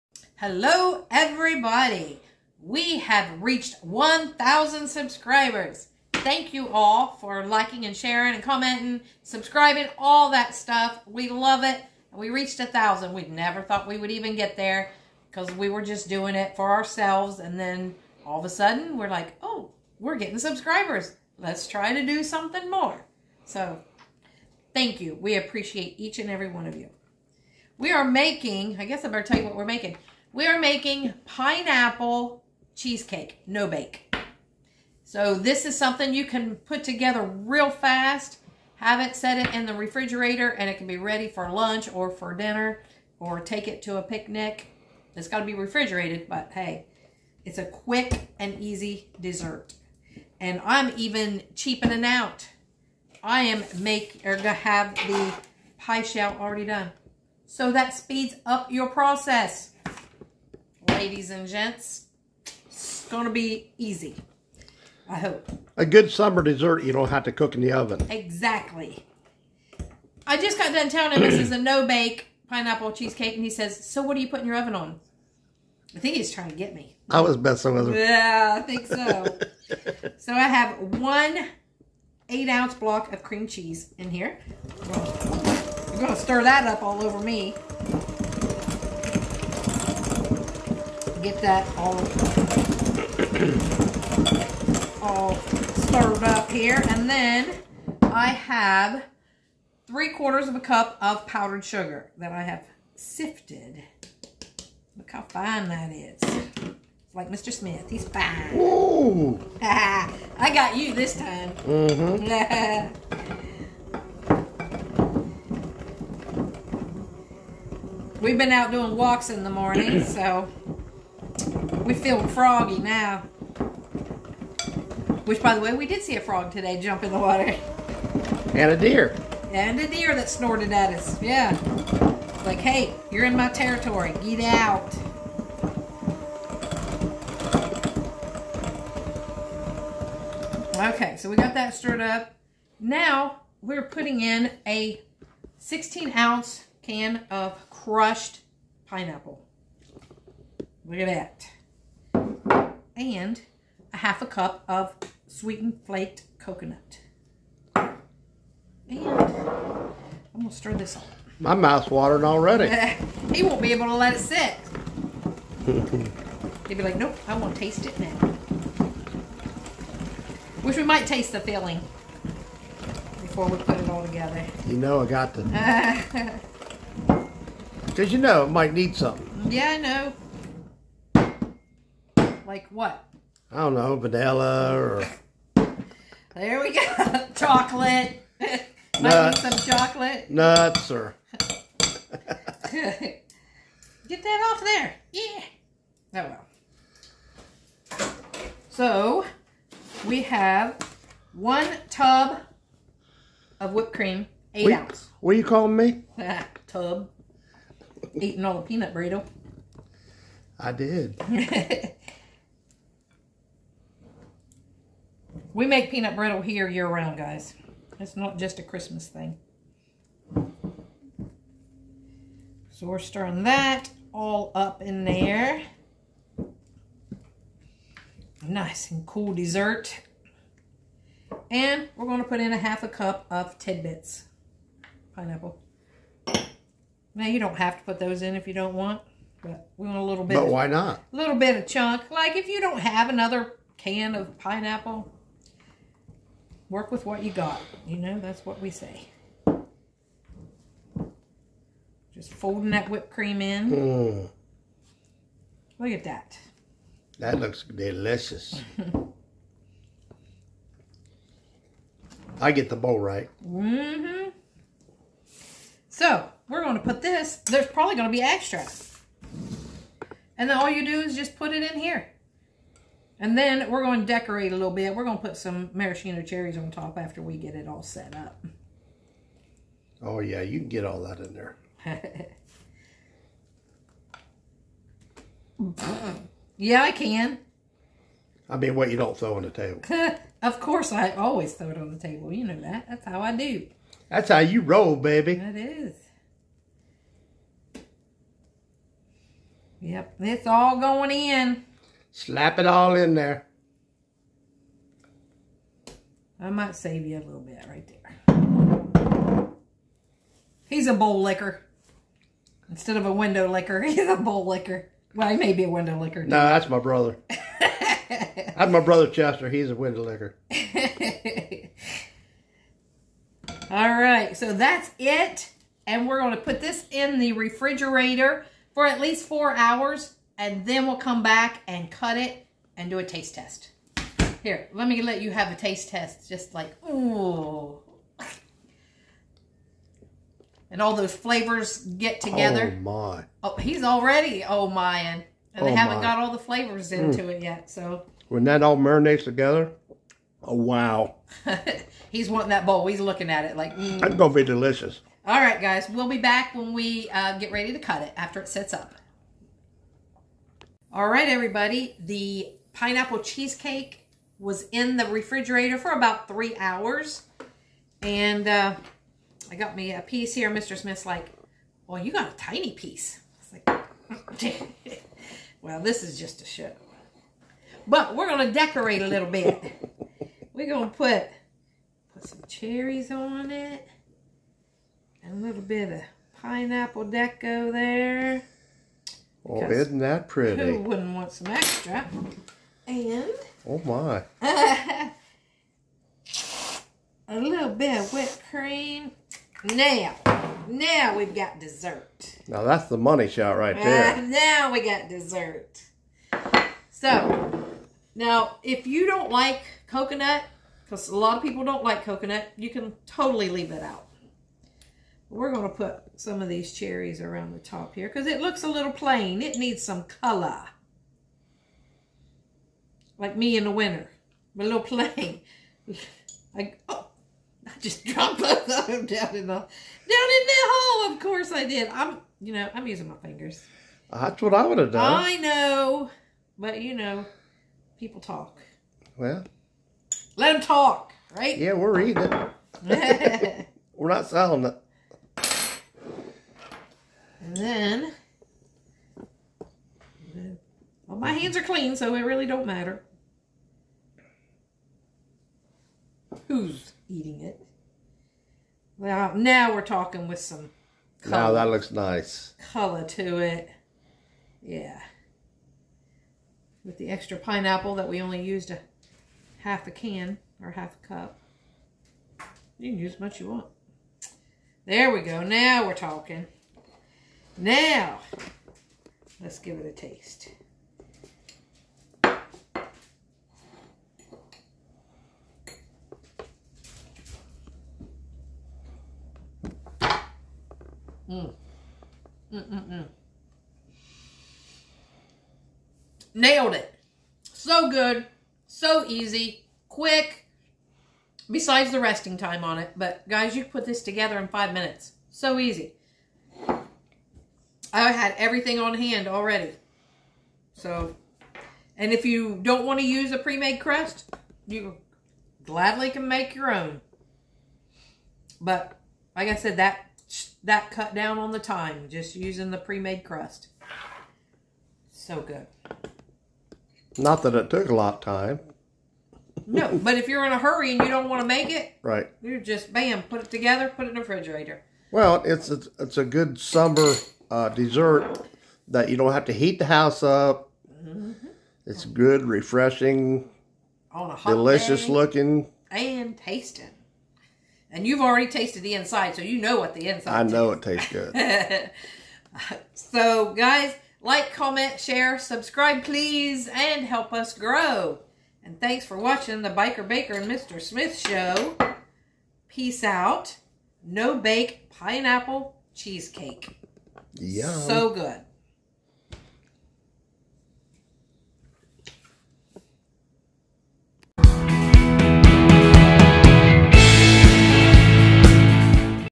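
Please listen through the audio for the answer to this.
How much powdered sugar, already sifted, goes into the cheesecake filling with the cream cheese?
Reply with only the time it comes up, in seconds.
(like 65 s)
99 s.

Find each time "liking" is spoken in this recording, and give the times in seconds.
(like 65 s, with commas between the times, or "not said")
7 s.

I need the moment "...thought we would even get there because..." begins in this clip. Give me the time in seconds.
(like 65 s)
13 s.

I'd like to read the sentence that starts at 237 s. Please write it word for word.
Now, you don't have to put those in if you don't want, but we want a little bit.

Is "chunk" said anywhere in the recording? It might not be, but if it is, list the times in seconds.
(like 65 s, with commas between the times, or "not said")
241 s.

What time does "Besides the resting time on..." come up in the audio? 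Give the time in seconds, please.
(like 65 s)
501 s.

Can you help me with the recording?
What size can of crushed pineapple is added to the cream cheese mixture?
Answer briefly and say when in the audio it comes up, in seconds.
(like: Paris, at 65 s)
16 ounce, at 145 s.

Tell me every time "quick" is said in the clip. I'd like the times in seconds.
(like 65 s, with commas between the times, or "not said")
47 s, 499 s.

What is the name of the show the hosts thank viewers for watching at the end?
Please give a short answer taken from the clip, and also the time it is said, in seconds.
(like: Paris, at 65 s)
The Biker Baker and Mr. Smith show, at 559 s.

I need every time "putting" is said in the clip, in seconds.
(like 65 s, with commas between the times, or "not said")
74 s, 143 s.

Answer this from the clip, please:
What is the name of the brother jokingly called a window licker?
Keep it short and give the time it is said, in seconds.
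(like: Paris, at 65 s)
Chester, at 319 s.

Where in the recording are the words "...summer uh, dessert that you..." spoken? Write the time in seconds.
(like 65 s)
536 s.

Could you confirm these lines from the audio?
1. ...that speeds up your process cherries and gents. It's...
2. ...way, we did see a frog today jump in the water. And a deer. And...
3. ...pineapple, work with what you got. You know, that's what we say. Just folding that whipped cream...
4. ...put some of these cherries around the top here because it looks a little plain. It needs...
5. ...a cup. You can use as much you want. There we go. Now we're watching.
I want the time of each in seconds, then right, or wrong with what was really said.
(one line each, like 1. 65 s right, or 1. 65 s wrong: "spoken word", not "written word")
1. 57 s wrong: "ladies", not "cherries"
2. 125 s right
3. 244 s right
4. 415 s right
5. 471 s wrong: "talking", not "watching".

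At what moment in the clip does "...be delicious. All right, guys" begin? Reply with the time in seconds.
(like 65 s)
354 s.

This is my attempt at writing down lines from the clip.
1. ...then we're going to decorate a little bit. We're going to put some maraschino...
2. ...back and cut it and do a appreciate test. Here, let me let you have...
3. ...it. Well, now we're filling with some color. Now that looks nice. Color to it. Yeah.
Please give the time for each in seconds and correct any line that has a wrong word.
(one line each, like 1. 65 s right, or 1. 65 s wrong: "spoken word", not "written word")
1. 273 s right
2. 331 s wrong: "taste", not "appreciate"
3. 457 s wrong: "talking", not "filling".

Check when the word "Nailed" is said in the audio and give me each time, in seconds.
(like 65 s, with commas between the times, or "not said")
496 s.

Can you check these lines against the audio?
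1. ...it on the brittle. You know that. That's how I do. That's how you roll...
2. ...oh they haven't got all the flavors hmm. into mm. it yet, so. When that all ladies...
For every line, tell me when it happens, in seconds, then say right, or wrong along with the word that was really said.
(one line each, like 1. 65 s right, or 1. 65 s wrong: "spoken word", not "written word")
1. 291 s wrong: "table", not "brittle"
2. 345 s wrong: "marinates", not "ladies".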